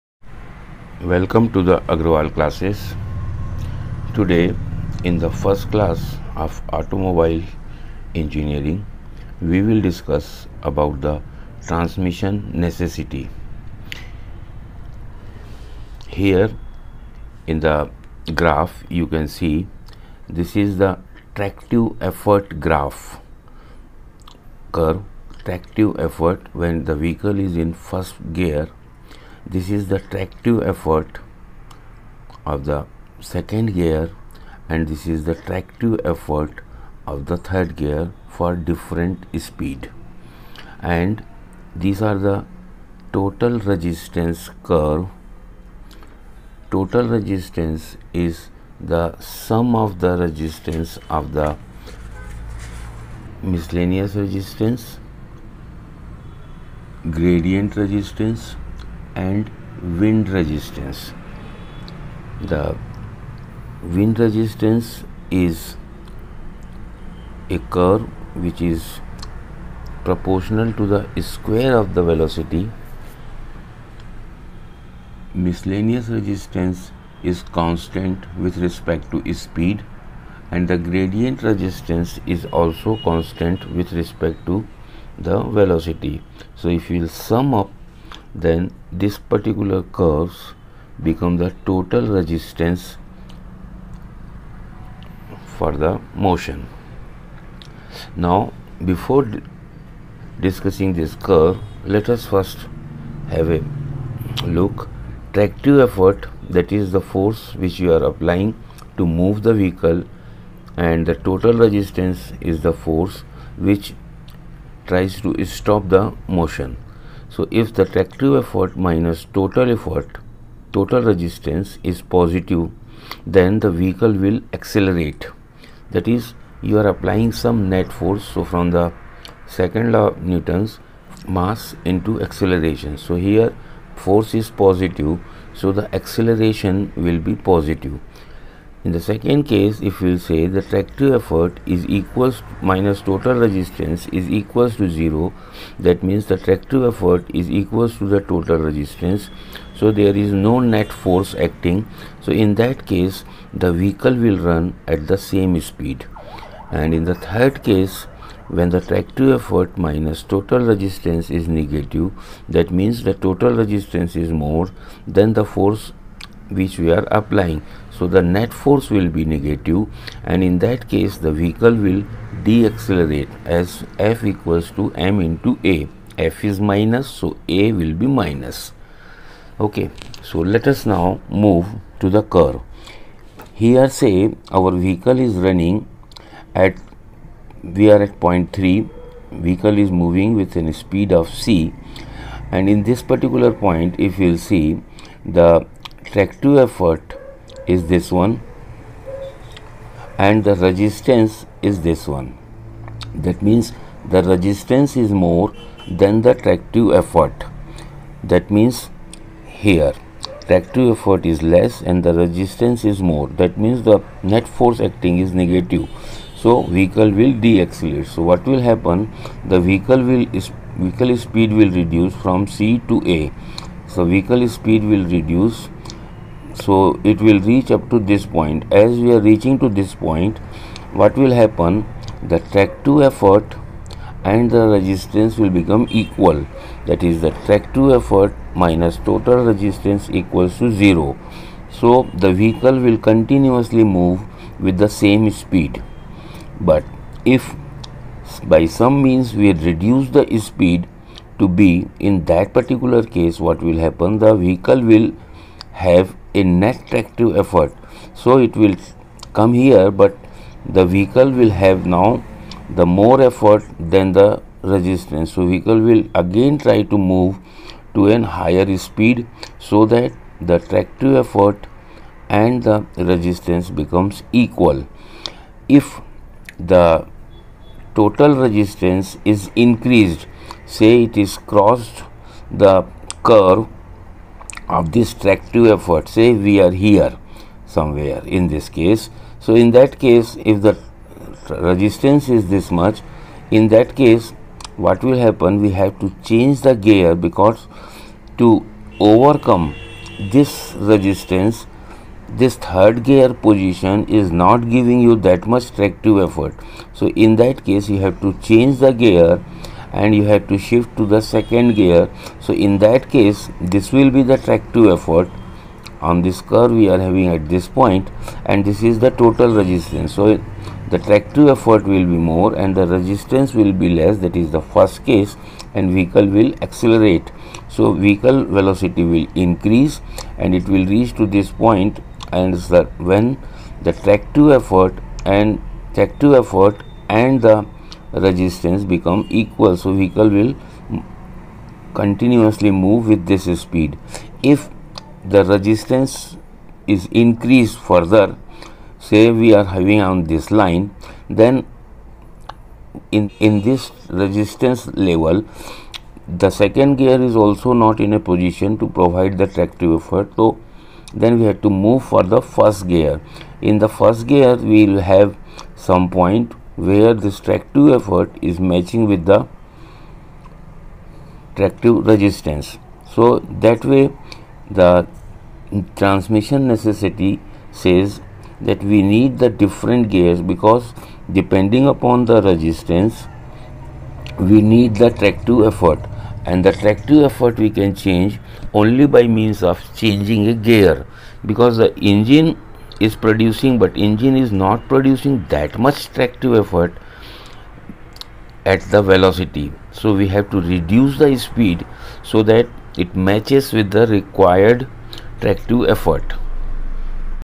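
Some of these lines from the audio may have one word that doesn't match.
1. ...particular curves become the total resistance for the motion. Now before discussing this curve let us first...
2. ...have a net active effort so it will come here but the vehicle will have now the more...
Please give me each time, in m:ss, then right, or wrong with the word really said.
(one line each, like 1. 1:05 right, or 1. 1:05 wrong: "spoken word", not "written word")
1. 1:29 right
2. 4:15 right.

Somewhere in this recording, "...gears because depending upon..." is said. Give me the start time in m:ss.
6:20.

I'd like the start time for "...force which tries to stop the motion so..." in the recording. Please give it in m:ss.
1:52.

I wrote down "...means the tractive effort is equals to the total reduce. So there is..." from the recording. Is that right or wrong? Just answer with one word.
wrong.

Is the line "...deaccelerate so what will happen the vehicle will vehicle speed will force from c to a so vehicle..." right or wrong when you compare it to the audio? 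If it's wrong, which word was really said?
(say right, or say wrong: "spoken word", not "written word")
wrong: "reduce", not "force".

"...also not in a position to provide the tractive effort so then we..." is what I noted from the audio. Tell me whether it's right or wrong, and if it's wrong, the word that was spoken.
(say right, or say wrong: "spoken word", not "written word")
right.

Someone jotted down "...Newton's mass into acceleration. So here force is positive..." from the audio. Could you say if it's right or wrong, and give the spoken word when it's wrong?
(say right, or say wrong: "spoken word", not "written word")
right.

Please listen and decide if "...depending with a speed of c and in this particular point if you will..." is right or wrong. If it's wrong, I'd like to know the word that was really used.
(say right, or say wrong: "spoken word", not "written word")
wrong: "moving", not "depending".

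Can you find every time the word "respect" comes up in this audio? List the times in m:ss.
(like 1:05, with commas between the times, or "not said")
1:18, 1:23.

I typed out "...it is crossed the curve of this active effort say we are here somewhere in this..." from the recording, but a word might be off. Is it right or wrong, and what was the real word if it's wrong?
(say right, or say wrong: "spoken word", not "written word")
wrong: "tractive", not "active".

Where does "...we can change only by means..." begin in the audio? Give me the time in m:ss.
6:27.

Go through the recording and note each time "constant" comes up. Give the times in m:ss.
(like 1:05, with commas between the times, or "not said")
1:17, 1:23.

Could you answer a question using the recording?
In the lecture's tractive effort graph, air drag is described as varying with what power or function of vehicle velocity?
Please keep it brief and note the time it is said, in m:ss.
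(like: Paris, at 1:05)
Square of the velocity, at 1:11.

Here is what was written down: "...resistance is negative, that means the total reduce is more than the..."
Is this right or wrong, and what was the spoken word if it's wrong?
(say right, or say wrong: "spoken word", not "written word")
wrong: "resistance", not "reduce".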